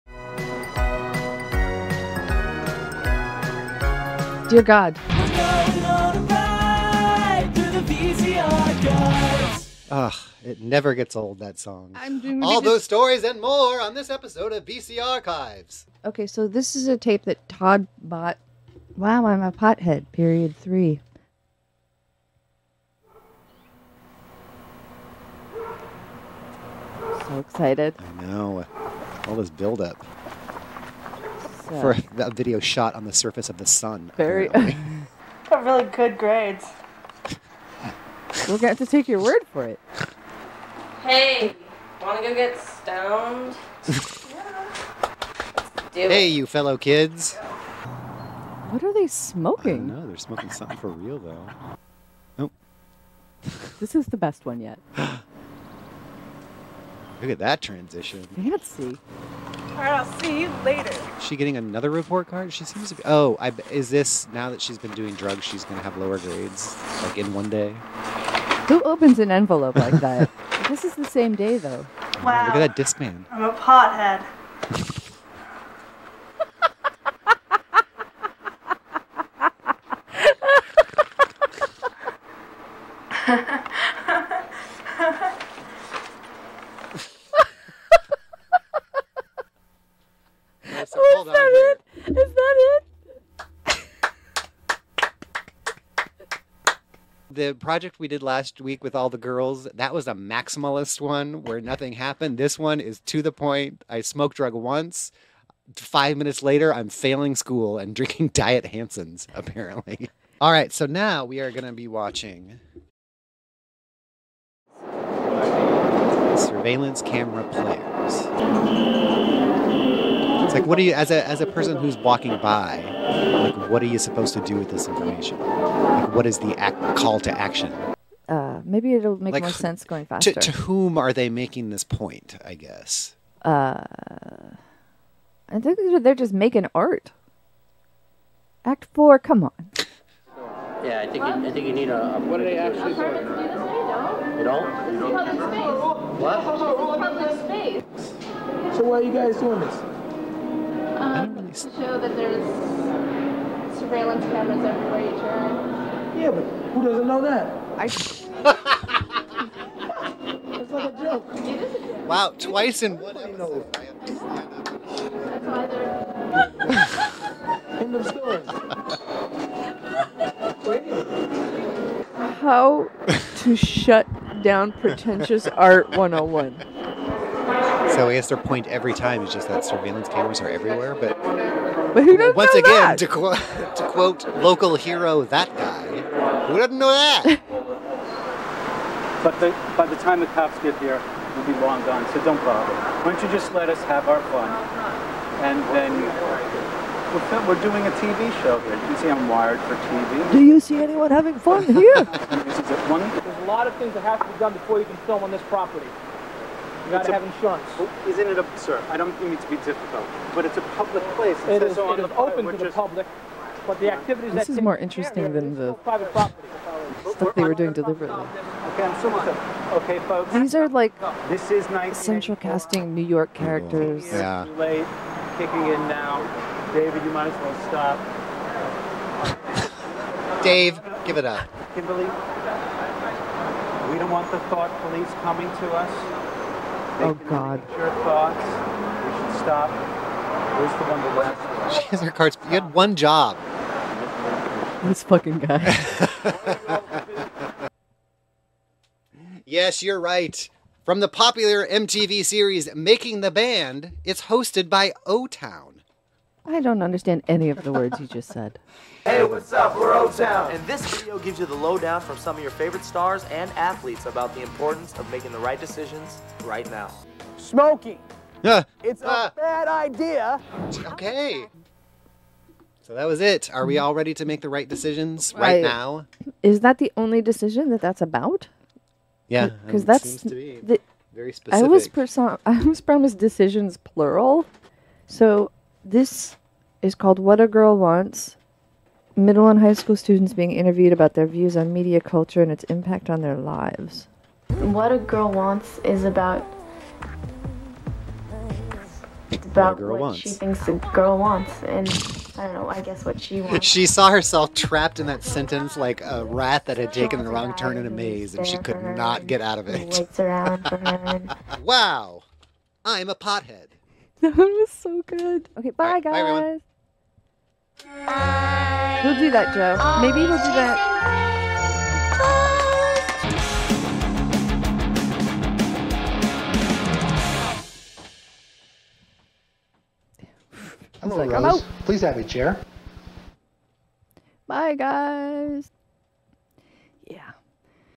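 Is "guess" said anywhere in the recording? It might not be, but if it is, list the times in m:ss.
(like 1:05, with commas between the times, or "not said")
2:12, 2:58, 5:02.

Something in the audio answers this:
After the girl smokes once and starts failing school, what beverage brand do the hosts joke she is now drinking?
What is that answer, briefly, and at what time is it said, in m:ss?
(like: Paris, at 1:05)
Diet Hansen's, at 1:48.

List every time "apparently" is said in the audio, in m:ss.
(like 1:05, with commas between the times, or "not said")
1:49.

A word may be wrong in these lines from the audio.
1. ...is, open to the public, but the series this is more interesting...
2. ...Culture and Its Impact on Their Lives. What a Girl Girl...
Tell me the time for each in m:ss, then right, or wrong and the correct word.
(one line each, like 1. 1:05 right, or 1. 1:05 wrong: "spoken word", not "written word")
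1. 3:31 wrong: "activities", not "series"
2. 4:51 wrong: "Wants", not "Girl".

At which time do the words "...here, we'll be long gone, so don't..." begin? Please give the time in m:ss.
3:10.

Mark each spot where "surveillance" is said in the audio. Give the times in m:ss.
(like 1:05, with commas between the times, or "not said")
1:56, 2:33, 2:59.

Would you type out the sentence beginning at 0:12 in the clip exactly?
All those stories and more on this episode of VC Archives.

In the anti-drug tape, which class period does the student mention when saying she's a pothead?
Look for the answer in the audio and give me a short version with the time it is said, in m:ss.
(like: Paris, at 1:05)
Period three, at 0:20.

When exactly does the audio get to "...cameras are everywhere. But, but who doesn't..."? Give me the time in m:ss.
3:00.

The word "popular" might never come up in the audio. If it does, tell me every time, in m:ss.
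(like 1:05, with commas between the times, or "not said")
4:11.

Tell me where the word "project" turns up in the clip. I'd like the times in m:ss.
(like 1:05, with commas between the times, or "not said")
1:37.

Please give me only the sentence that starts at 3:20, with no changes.
Do you see anyone having fun here?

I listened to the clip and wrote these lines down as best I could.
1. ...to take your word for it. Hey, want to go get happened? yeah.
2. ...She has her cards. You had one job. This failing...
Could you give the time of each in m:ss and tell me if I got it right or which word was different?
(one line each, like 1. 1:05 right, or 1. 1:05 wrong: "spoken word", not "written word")
1. 0:38 wrong: "stoned", not "happened"
2. 4:01 wrong: "fucking", not "failing".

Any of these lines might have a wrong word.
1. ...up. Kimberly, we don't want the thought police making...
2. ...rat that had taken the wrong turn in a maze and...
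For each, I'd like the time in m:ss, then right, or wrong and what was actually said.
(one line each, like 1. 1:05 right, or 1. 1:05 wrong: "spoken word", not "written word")
1. 3:51 wrong: "coming", not "making"
2. 5:06 right.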